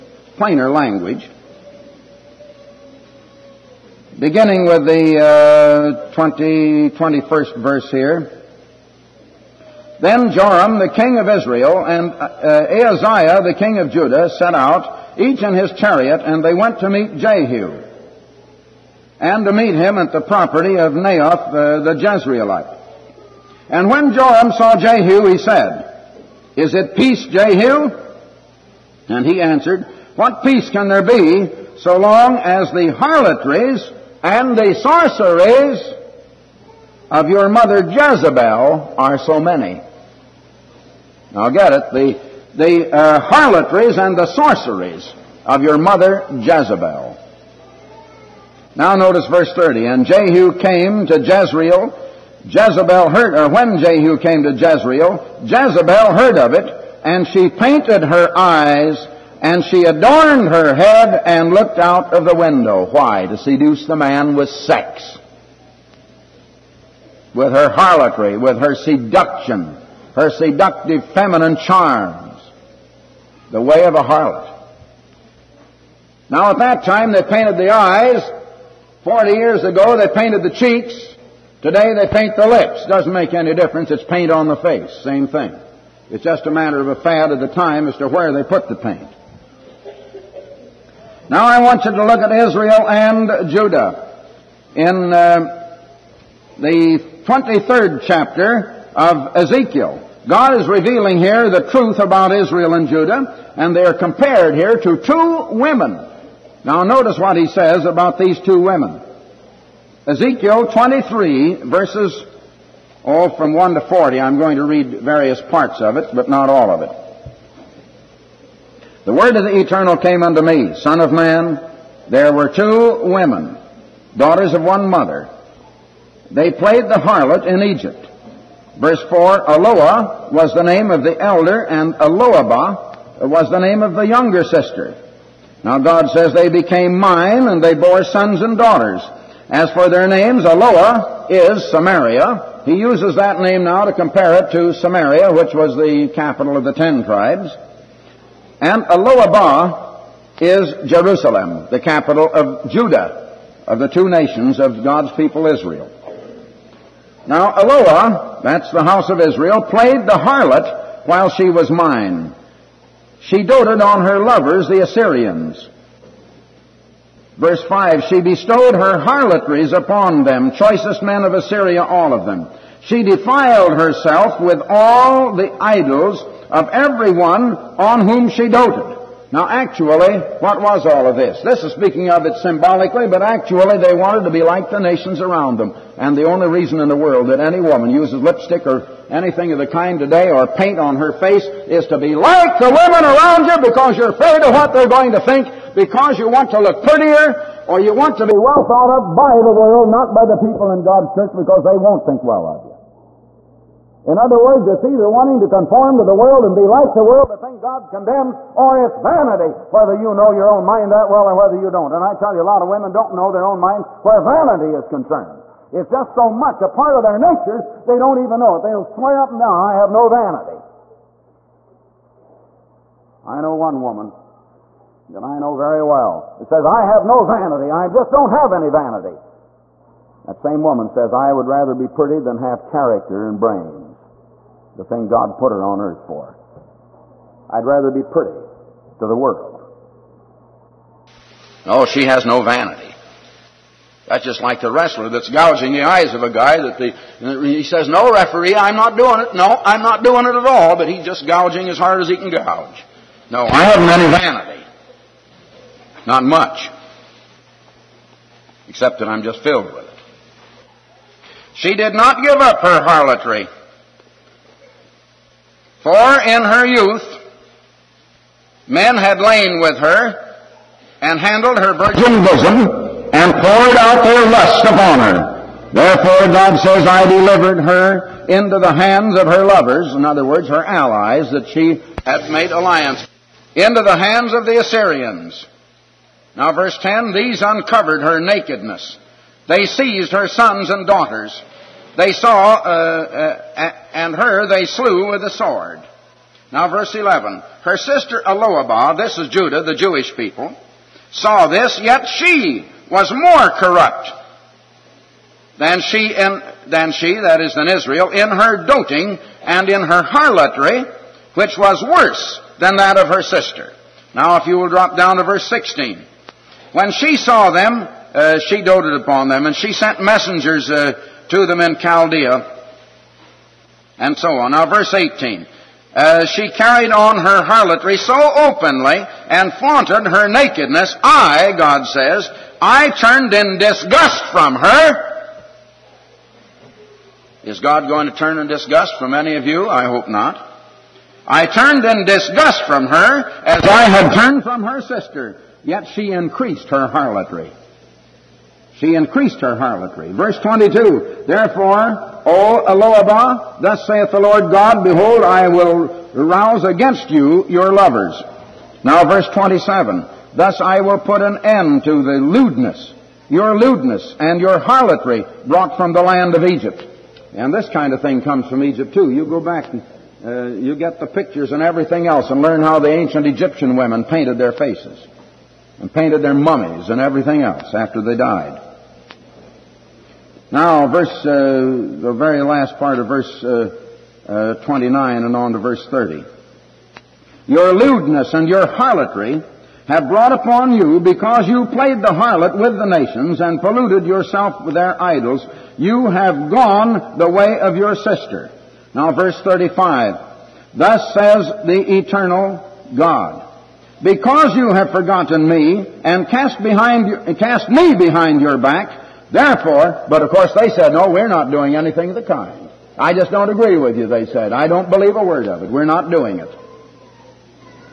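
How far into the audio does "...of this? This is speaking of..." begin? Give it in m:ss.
3:01.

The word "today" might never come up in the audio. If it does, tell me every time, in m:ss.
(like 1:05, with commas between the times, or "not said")
1:21, 3:09.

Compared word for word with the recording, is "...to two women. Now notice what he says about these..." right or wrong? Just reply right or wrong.
right.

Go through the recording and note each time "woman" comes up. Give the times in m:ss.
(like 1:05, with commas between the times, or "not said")
3:07, 3:43, 3:50.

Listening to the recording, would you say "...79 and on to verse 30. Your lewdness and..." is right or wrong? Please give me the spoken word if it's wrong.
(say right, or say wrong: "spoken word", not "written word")
wrong: "29", not "79".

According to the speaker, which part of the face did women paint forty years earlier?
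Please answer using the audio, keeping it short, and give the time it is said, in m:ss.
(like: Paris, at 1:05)
The cheeks, at 1:20.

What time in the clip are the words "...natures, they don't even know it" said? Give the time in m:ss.
3:37.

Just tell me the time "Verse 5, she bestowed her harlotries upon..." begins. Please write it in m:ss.
2:47.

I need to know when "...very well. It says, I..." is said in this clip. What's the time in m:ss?
3:45.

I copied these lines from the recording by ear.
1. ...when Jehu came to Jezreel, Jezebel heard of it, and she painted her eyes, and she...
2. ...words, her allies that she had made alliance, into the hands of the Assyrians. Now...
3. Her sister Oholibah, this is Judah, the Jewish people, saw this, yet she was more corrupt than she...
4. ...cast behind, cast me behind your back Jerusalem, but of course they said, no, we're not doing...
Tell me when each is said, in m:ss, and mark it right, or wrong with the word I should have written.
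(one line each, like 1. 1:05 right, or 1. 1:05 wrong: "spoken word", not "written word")
1. 0:53 right
2. 4:40 right
3. 4:57 right
4. 6:46 wrong: "Therefore", not "Jerusalem".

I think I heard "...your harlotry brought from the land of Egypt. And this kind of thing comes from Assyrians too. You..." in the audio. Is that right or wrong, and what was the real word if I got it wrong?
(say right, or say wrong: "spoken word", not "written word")
wrong: "Egypt", not "Assyrians".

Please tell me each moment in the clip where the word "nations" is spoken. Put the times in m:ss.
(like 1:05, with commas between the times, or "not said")
2:34, 3:04, 6:32.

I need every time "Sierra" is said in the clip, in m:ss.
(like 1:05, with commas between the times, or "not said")
not said.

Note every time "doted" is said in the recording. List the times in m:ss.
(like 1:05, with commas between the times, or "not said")
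2:43, 2:58, 5:18.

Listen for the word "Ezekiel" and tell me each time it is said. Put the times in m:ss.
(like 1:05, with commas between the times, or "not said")
1:39, 1:50.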